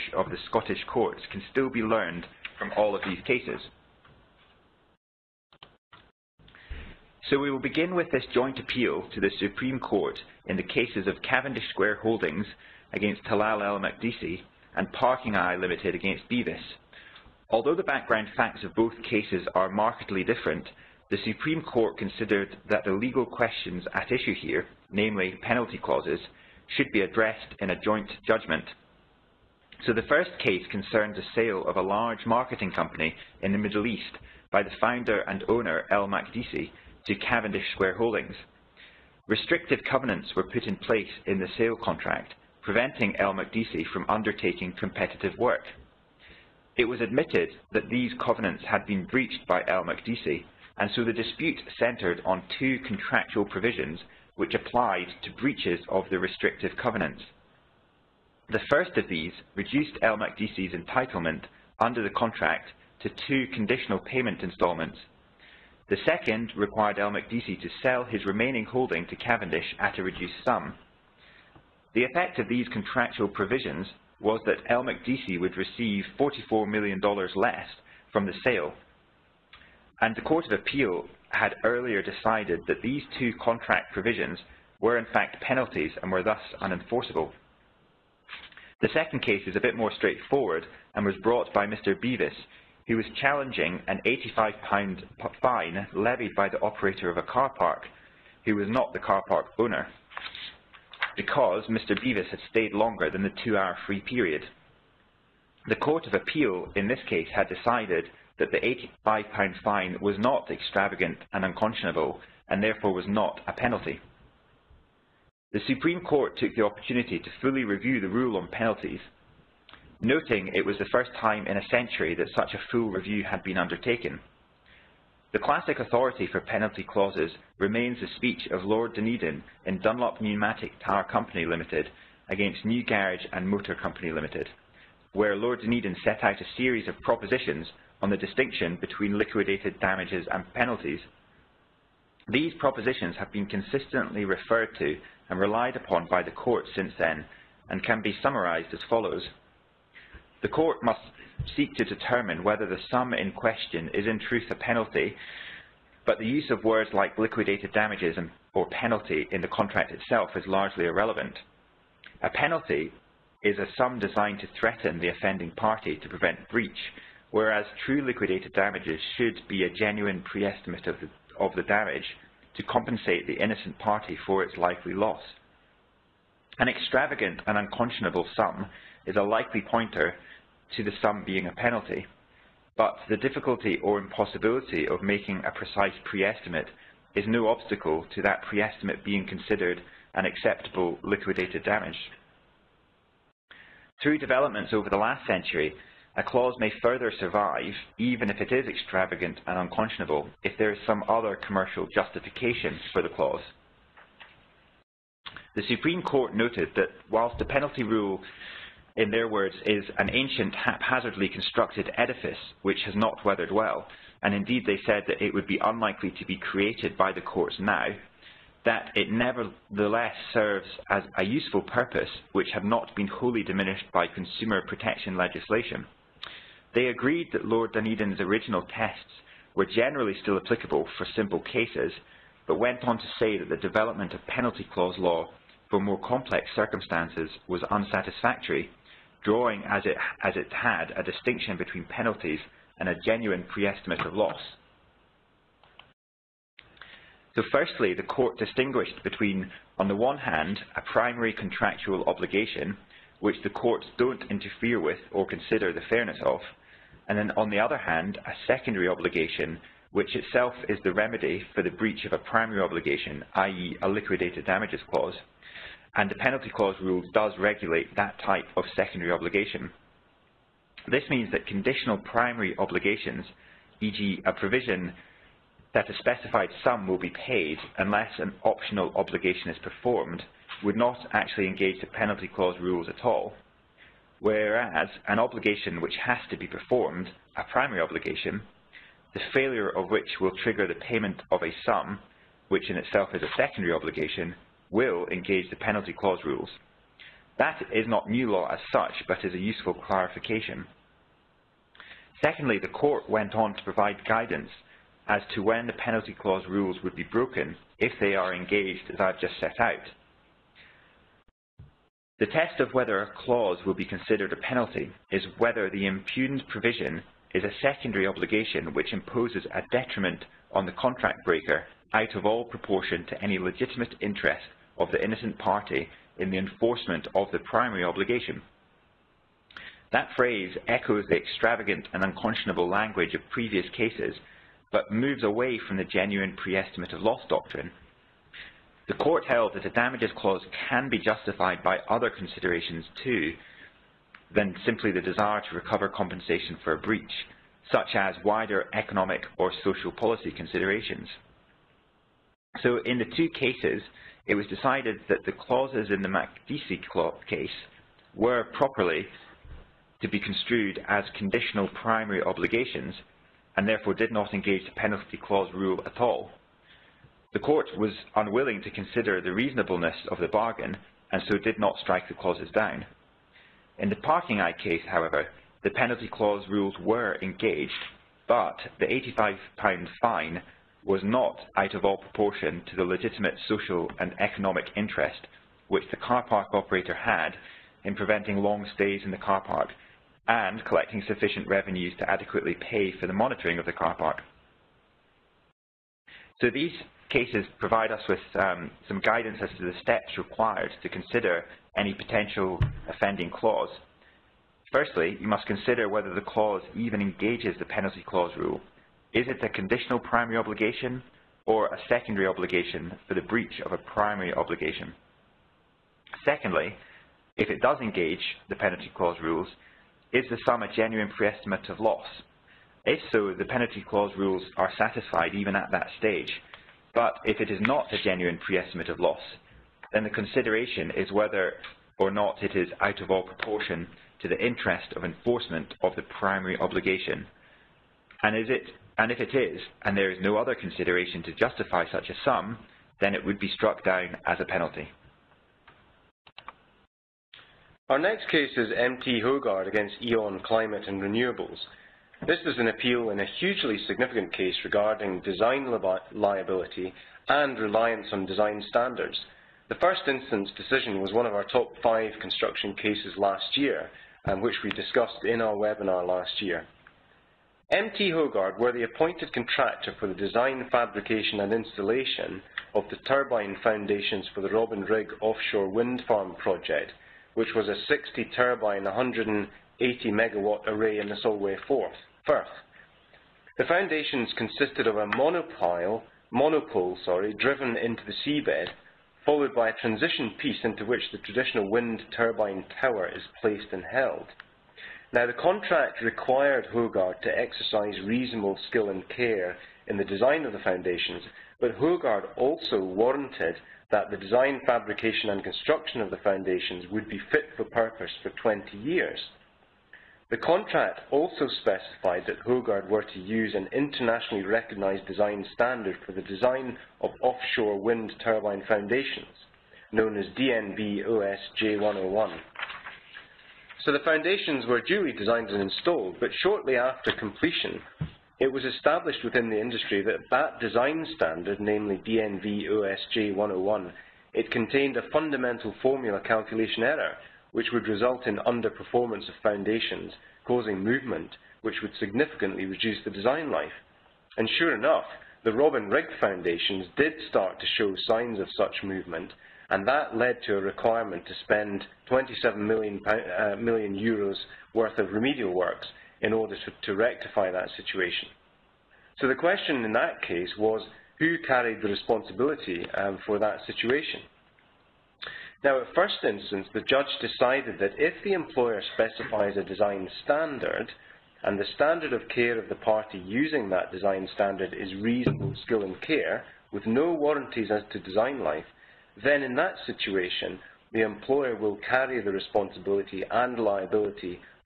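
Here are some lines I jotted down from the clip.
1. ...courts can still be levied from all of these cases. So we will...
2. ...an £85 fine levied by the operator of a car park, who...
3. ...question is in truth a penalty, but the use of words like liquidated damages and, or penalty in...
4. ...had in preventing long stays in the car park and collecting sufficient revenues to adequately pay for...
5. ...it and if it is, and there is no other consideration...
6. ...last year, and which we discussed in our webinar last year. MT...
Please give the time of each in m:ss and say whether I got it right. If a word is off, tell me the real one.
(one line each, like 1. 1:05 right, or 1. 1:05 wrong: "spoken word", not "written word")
1. 0:00 wrong: "learned", not "levied"
2. 1:33 right
3. 2:33 right
4. 6:26 right
5. 7:18 right
6. 7:43 right.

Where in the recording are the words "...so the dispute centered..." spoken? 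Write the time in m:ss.
0:50.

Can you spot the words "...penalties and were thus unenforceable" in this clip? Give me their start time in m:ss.
1:25.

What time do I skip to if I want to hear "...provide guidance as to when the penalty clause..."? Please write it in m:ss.
5:03.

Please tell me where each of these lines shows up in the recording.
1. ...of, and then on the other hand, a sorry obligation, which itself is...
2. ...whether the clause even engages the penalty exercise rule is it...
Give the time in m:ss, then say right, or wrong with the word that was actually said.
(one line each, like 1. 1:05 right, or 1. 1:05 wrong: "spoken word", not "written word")
1. 4:16 wrong: "secondary", not "sorry"
2. 6:45 wrong: "clause", not "exercise".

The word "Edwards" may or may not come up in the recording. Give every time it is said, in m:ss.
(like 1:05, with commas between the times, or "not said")
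not said.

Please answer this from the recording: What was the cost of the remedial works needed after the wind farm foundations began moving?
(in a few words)
27 million euros.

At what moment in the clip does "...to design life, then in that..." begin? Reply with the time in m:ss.
9:37.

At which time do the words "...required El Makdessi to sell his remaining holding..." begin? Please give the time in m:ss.
1:06.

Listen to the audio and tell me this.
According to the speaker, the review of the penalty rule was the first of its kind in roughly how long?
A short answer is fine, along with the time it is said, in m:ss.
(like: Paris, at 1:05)
a century, at 2:01.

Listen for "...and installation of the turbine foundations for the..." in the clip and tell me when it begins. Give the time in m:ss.
7:51.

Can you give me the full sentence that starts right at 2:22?
These propositions have been consistently referred to and relied upon by the court since then and can be summarised as follows.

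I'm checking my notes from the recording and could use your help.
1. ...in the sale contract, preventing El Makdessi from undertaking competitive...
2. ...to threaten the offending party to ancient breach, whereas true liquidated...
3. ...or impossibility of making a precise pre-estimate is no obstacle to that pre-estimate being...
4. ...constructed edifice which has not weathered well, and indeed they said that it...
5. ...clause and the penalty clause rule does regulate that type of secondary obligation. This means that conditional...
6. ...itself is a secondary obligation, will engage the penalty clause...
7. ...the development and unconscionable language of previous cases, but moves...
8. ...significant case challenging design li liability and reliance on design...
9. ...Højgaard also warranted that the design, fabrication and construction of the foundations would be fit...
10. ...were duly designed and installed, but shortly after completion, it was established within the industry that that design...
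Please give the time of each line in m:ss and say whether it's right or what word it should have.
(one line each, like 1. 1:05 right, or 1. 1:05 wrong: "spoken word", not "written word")
1. 0:41 right
2. 2:44 wrong: "prevent", not "ancient"
3. 3:03 right
4. 3:31 right
5. 4:24 right
6. 4:52 right
7. 5:31 wrong: "extravagant", not "development"
8. 7:33 wrong: "regarding", not "challenging"
9. 8:21 right
10. 8:44 right.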